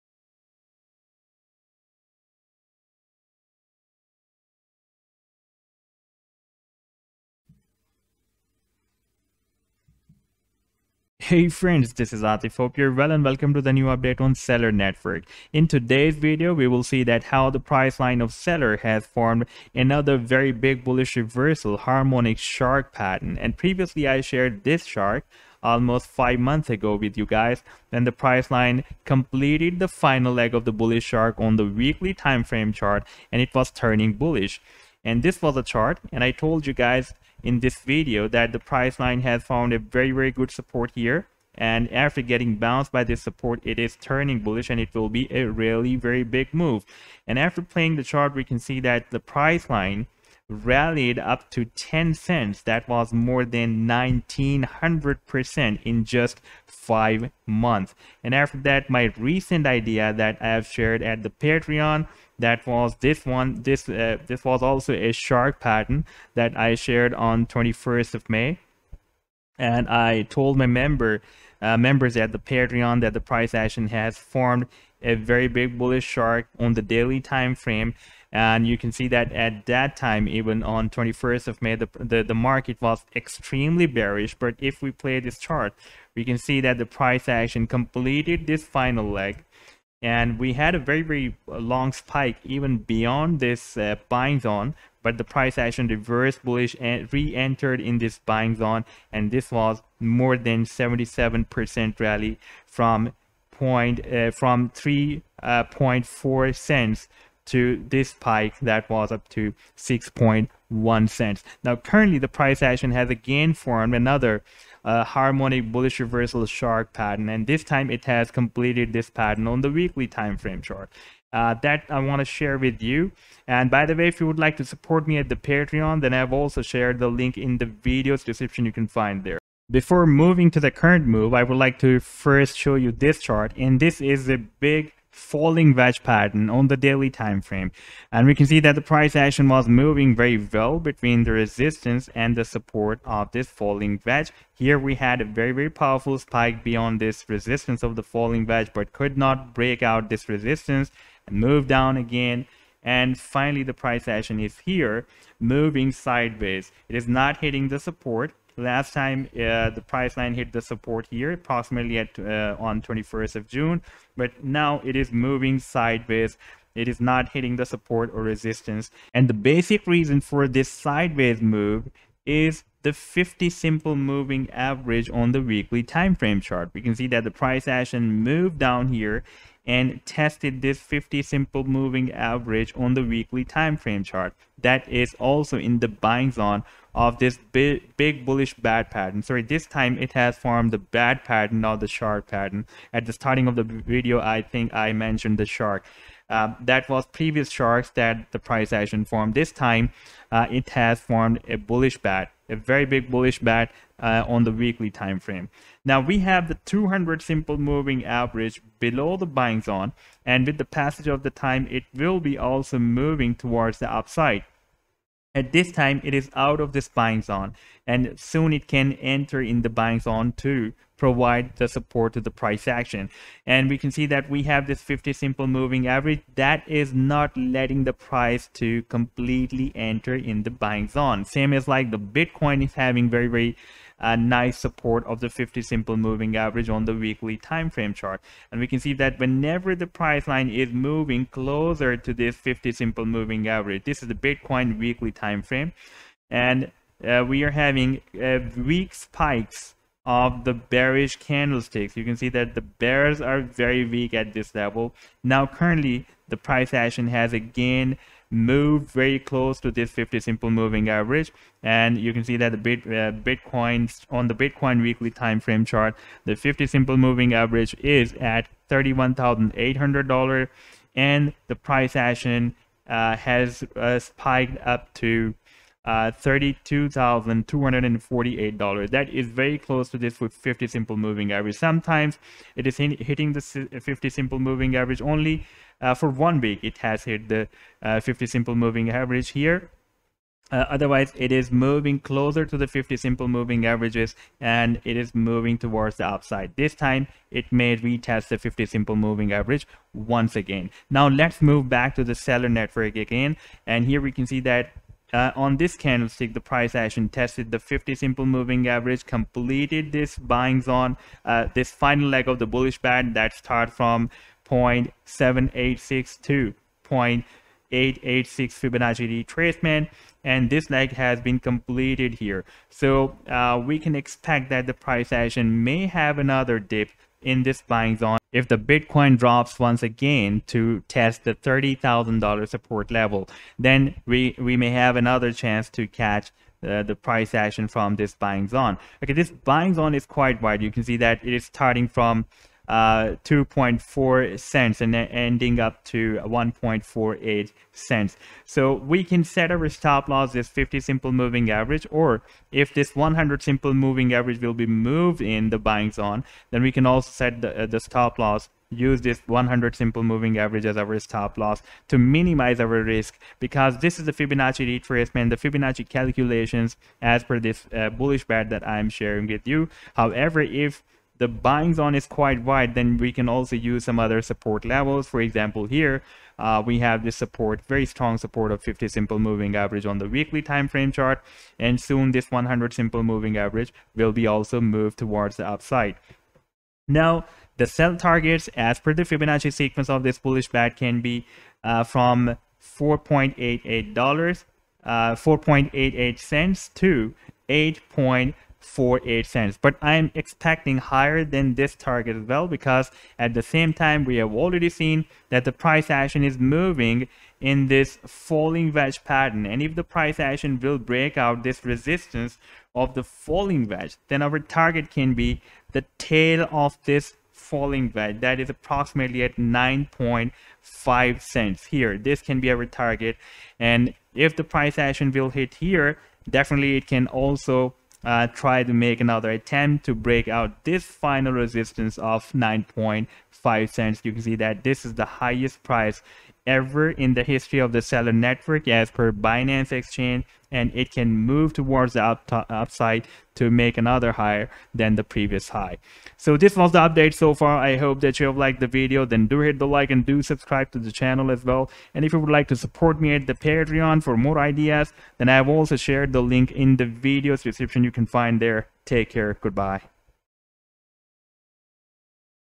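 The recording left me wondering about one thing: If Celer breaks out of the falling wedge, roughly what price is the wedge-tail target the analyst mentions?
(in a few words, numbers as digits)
9.5 cents.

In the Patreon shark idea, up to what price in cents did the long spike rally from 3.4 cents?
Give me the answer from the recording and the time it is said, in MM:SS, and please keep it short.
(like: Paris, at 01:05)
6.1 cents, at 01:49.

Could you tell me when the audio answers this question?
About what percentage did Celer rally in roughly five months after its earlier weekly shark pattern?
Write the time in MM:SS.
00:53.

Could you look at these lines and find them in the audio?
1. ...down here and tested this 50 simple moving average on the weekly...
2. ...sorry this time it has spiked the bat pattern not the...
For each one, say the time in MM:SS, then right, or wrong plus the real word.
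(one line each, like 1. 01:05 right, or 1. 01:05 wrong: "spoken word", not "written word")
1. 02:58 right
2. 03:09 wrong: "formed", not "spiked".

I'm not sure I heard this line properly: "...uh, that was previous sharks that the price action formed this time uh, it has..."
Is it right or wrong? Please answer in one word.
right.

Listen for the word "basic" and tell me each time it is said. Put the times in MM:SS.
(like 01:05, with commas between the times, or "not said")
02:49.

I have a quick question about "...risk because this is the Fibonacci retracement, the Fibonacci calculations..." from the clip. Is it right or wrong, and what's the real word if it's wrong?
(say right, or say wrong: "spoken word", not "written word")
right.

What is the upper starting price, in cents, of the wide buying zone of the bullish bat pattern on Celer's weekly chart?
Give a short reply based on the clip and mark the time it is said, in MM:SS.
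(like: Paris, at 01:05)
2.4 cents, at 05:43.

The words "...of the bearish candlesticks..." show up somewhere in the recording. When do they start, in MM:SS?
04:10.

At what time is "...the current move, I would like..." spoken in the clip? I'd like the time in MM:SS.
02:10.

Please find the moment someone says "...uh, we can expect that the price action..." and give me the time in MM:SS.
05:23.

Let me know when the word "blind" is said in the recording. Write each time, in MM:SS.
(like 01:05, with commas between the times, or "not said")
not said.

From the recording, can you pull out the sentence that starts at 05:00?
Now, let's move back to the Celer network again.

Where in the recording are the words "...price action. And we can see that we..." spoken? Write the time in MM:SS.
03:42.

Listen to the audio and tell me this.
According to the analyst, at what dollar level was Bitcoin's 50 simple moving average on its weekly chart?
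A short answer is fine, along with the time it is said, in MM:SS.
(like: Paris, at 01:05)
$31,800, at 04:28.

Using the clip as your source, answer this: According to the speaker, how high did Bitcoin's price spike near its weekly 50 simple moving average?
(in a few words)
$32,248.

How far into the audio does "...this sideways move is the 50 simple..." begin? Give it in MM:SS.
02:50.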